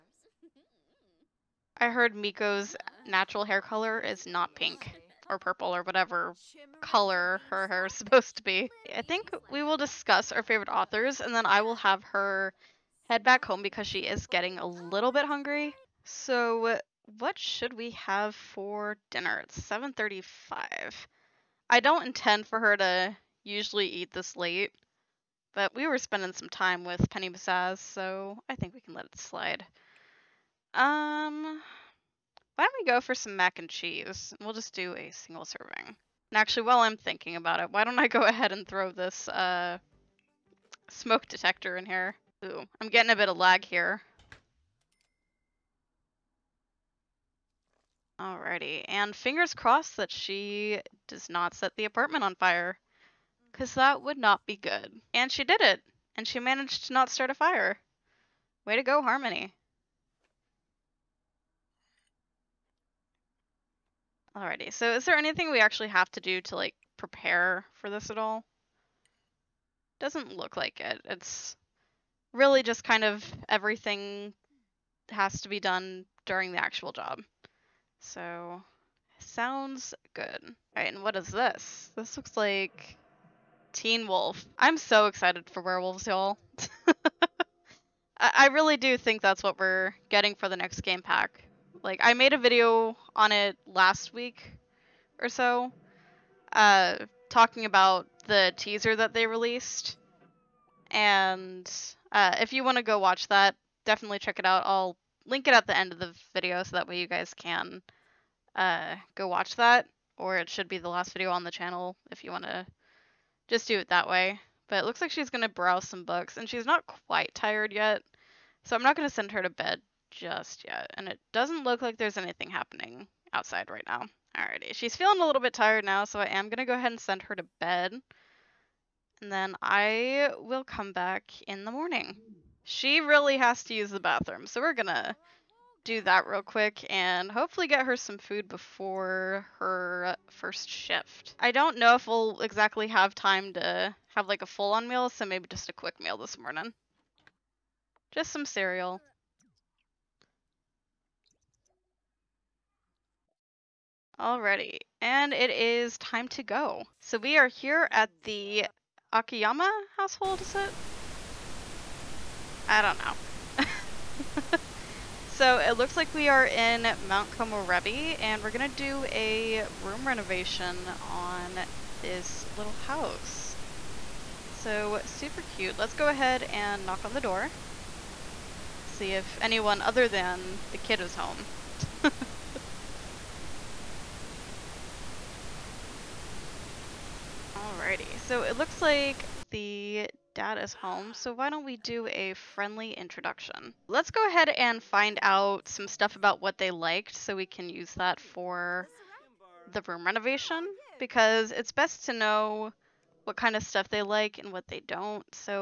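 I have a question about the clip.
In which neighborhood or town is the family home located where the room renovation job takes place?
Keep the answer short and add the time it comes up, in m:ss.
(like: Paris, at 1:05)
Mount Komorebi, at 2:46.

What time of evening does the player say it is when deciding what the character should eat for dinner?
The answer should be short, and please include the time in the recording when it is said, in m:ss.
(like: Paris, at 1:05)
7:35, at 0:19.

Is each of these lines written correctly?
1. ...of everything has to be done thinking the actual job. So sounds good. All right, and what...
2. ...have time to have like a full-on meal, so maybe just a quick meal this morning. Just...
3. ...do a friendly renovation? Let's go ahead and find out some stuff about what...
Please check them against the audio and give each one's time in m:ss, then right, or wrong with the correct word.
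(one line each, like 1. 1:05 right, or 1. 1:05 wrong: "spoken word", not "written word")
1. 1:13 wrong: "during", not "thinking"
2. 2:22 right
3. 3:11 wrong: "introduction", not "renovation".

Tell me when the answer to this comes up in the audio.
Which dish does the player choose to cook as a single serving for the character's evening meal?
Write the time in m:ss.
0:33.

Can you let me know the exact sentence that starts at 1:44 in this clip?
I'll link it at the end of the video so that way you guys can uh, go watch that.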